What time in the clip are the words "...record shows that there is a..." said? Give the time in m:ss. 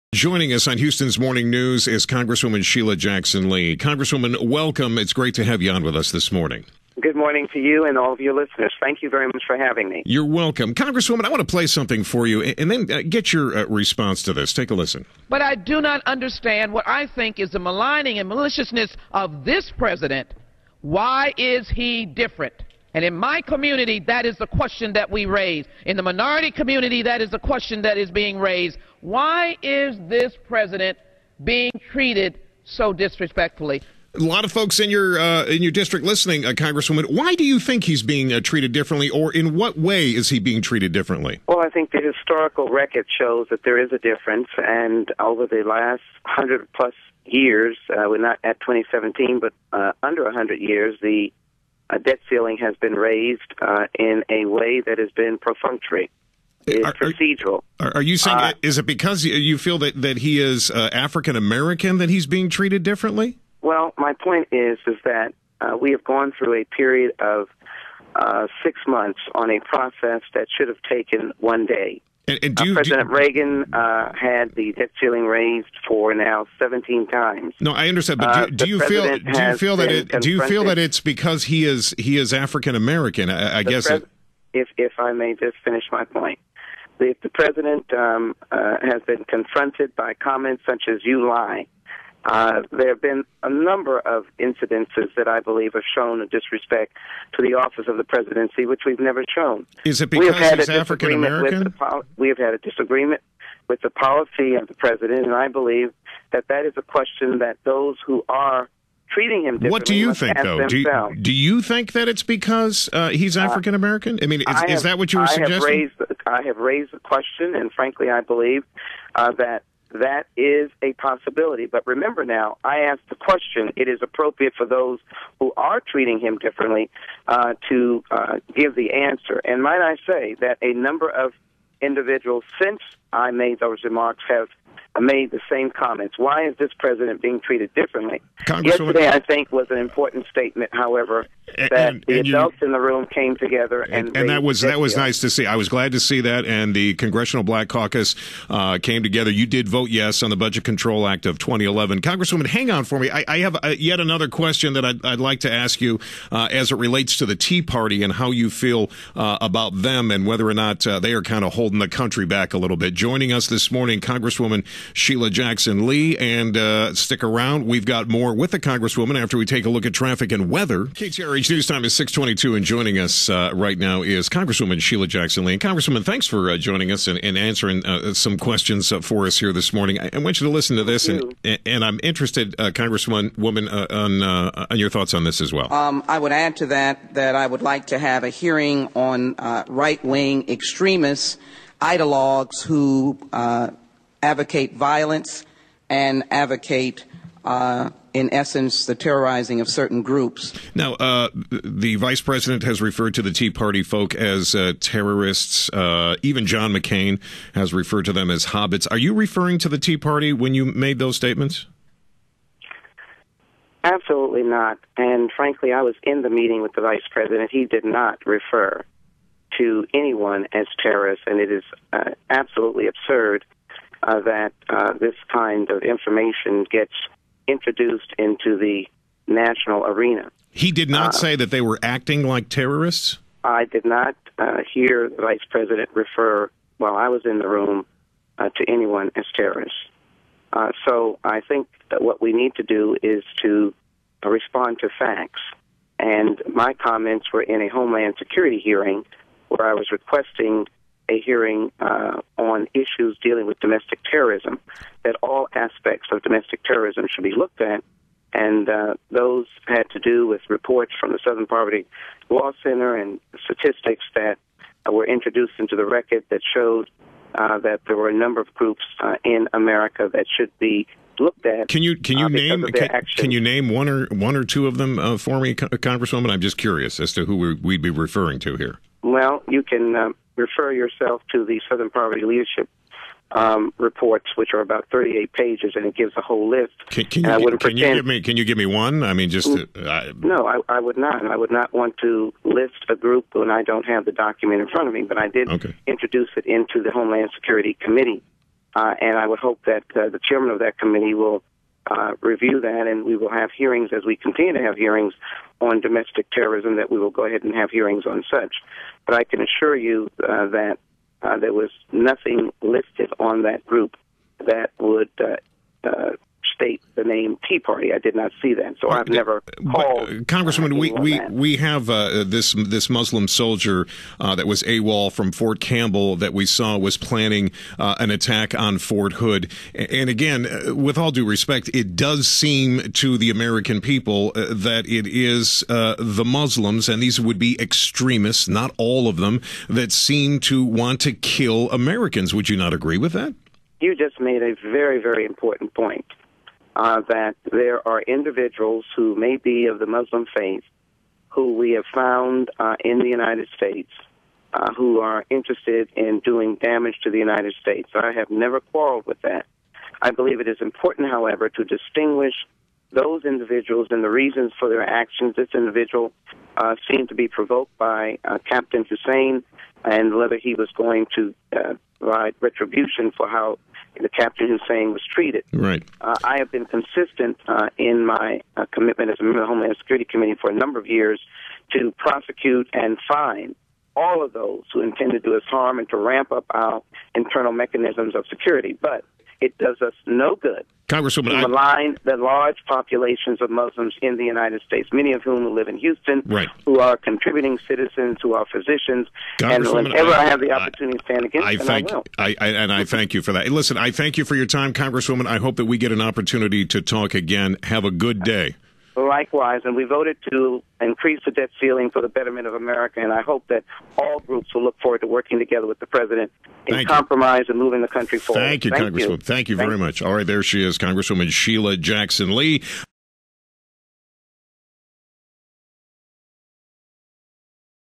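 0:42.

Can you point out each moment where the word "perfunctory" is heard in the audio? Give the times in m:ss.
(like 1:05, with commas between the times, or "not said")
0:55.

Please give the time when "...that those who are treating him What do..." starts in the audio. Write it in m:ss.
1:47.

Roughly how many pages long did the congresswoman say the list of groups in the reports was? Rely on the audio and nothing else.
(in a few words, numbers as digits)
38.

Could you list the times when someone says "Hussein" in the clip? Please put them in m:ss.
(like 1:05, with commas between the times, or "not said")
6:08, 6:14.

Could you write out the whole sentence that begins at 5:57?
I have never quarreled with that.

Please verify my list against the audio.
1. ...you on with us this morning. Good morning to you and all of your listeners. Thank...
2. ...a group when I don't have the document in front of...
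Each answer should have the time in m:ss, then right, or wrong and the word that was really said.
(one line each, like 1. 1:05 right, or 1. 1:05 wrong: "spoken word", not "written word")
1. 0:05 right
2. 4:52 right.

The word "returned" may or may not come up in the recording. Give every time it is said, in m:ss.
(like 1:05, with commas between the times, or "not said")
not said.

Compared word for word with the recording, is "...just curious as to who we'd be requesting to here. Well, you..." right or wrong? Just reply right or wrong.
wrong.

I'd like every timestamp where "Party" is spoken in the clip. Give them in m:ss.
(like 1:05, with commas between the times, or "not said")
2:37, 3:23, 3:29, 5:17.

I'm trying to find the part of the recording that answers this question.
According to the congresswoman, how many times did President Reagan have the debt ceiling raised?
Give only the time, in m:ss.
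1:16.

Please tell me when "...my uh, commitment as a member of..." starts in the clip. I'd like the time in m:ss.
6:18.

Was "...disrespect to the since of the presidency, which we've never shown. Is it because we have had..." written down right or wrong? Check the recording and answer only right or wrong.
wrong.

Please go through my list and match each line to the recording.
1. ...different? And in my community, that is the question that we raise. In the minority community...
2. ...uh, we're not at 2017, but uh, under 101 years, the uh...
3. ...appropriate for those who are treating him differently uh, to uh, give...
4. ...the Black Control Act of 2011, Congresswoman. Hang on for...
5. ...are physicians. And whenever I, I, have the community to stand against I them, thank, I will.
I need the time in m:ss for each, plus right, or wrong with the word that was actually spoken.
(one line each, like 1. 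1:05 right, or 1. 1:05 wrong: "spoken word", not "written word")
1. 0:22 right
2. 0:47 wrong: "100", not "101"
3. 2:04 right
4. 2:30 wrong: "Budget", not "Black"
5. 6:38 wrong: "opportunity", not "community".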